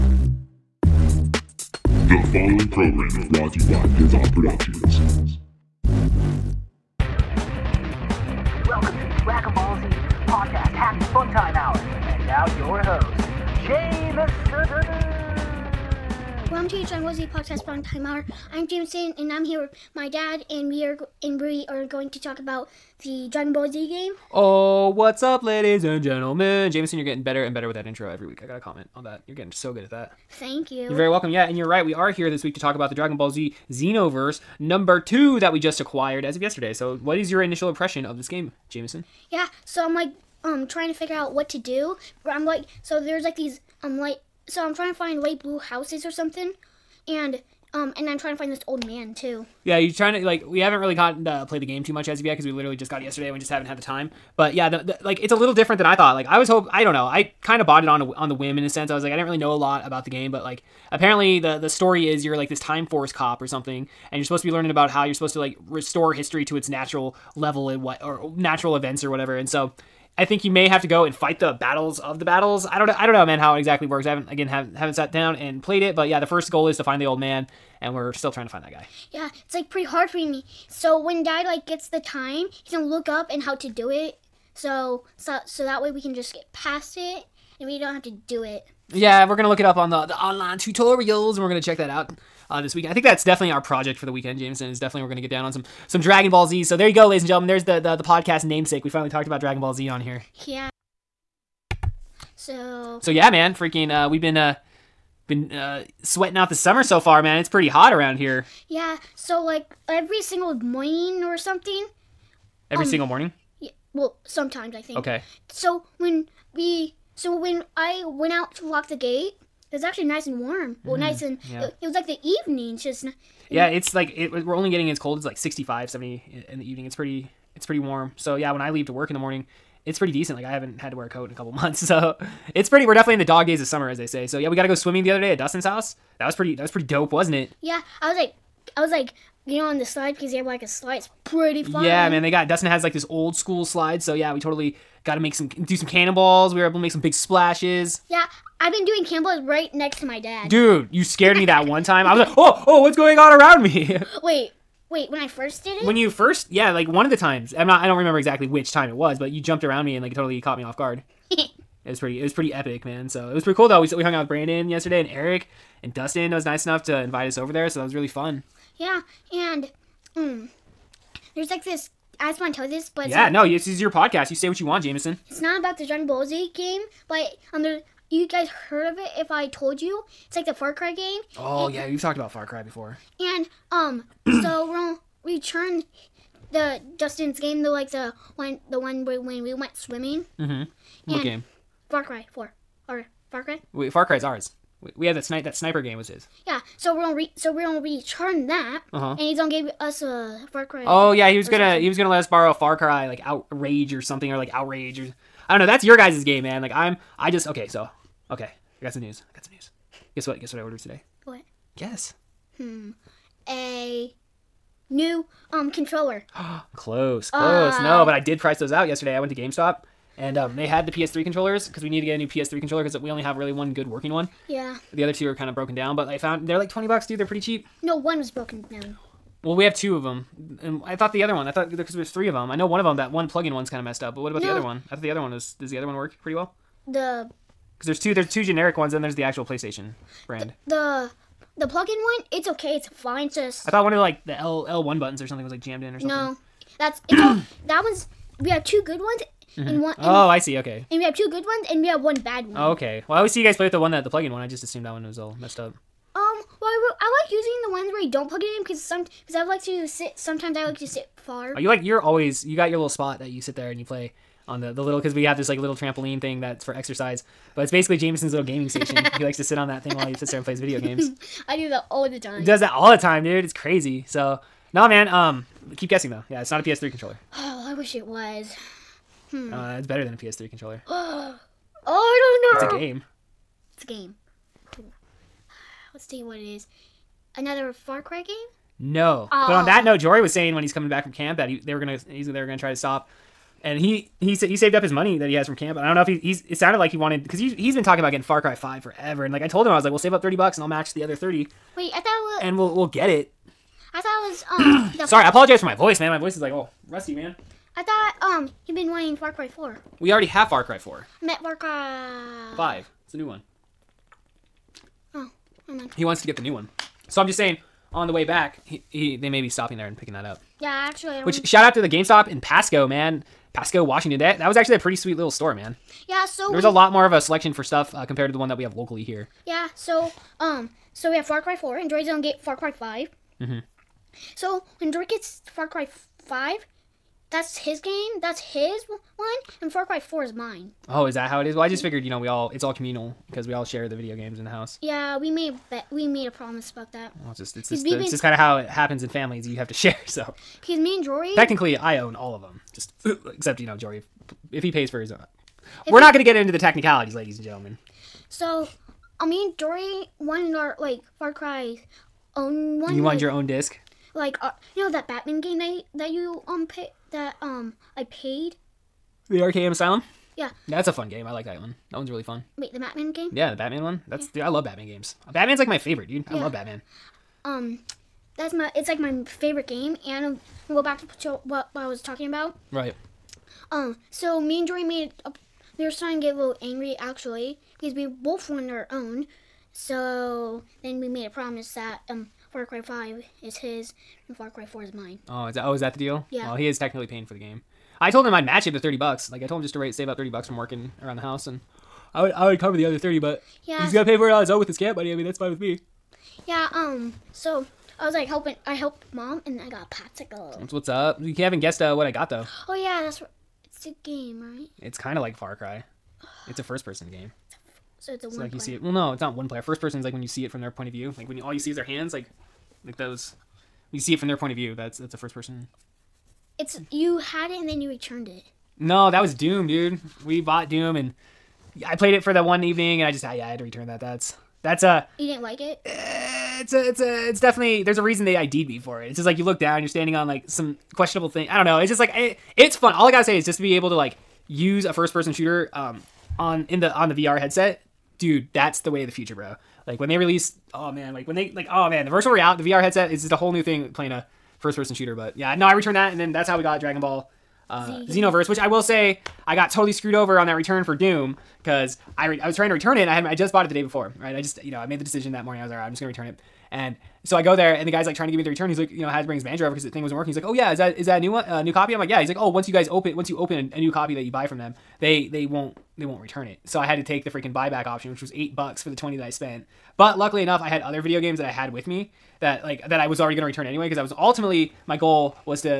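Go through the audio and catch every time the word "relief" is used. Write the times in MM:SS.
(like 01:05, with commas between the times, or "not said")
not said.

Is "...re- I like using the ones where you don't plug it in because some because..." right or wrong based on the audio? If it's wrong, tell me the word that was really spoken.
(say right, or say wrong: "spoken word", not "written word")
right.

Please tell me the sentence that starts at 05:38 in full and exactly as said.
That's his one, and Far Cry 4 is mine.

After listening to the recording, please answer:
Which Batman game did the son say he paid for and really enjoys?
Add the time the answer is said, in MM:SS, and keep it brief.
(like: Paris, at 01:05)
Arkham Asylum, at 06:09.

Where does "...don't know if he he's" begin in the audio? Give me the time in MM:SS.
04:55.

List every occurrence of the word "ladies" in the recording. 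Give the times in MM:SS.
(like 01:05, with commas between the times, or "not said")
00:25, 01:37, 05:57.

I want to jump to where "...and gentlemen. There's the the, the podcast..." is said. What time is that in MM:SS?
01:37.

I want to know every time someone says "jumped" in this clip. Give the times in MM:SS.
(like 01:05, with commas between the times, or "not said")
02:39.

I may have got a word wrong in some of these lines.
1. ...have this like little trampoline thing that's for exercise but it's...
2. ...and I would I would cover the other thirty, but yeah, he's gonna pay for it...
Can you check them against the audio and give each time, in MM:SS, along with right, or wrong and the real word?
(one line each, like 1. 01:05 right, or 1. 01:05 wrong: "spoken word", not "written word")
1. 04:25 right
2. 06:41 right.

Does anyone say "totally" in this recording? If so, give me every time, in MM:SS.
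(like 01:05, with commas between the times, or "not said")
02:24, 02:40, 07:39.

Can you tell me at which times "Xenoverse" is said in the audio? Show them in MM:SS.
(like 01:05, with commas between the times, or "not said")
00:33, 07:38.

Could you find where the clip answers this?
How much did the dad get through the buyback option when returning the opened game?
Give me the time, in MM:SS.
07:58.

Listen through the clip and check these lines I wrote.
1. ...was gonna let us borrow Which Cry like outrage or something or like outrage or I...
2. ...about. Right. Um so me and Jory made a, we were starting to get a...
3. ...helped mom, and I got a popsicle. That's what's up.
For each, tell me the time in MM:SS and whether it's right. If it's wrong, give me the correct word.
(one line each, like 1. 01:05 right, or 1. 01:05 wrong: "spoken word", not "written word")
1. 03:21 wrong: "Far", not "Which"
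2. 06:22 right
3. 06:48 right.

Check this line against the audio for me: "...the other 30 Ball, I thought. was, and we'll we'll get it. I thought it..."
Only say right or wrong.
wrong.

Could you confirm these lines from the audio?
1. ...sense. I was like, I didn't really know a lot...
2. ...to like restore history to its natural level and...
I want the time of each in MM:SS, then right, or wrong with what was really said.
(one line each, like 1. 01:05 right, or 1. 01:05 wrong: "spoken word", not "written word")
1. 00:58 right
2. 01:05 right.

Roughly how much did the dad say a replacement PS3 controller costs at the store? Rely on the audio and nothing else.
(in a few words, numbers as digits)
$20.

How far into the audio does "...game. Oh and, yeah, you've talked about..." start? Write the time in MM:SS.
03:00.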